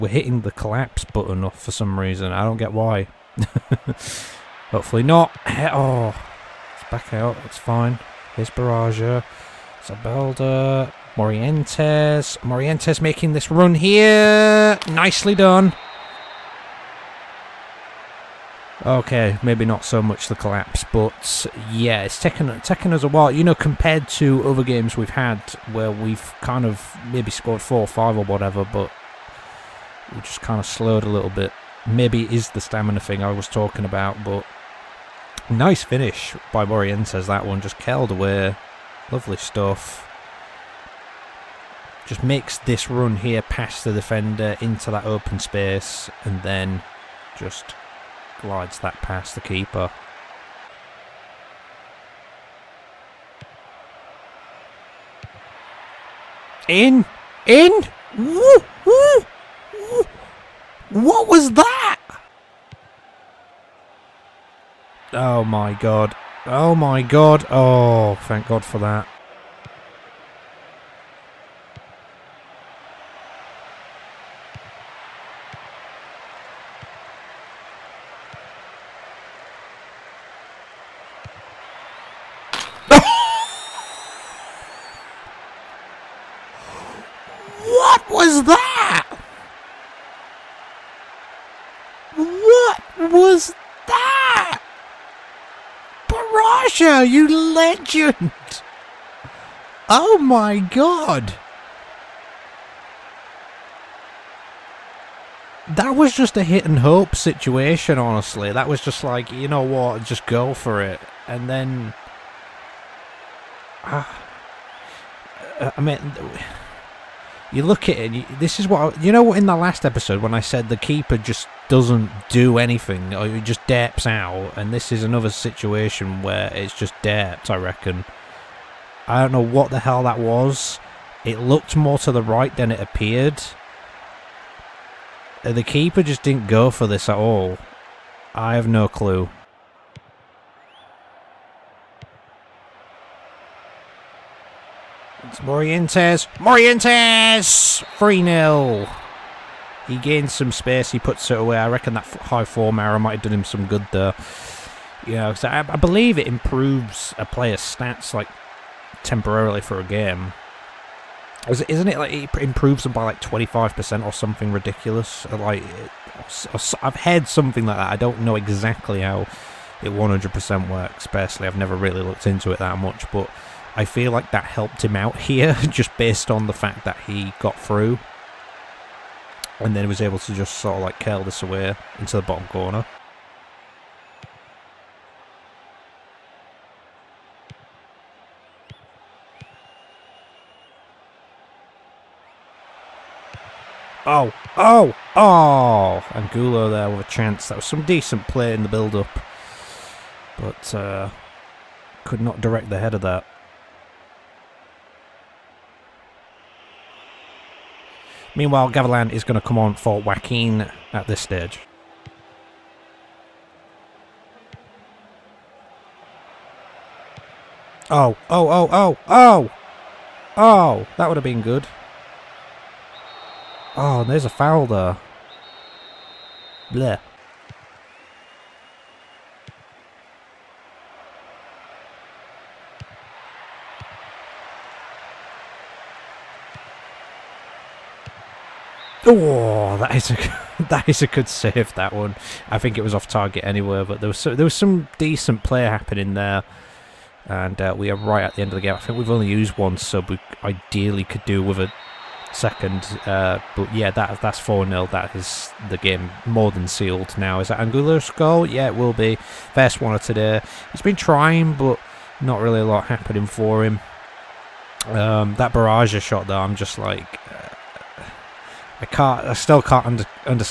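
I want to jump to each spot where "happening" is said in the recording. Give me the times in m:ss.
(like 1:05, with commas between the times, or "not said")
4:05, 4:22.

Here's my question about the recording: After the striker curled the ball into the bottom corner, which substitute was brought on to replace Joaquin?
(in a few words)
Gavilan.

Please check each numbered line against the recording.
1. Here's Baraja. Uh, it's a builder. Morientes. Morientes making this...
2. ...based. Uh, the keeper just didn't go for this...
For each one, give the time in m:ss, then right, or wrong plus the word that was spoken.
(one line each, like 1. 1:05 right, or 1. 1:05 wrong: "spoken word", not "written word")
1. 0:08 right
2. 2:12 wrong: "appeared", not "based".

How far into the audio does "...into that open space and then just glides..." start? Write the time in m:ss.
0:44.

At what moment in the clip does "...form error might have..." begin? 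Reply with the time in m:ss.
2:32.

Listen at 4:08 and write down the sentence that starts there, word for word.
I think we've only used one sub.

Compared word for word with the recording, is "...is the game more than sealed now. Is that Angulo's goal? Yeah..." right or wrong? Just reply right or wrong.
right.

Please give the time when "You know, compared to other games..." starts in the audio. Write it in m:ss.
0:23.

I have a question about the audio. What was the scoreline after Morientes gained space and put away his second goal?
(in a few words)
3-0.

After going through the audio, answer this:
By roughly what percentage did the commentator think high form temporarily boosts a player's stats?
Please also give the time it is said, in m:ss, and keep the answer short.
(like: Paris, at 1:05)
25%, at 2:43.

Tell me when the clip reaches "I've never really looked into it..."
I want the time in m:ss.
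2:51.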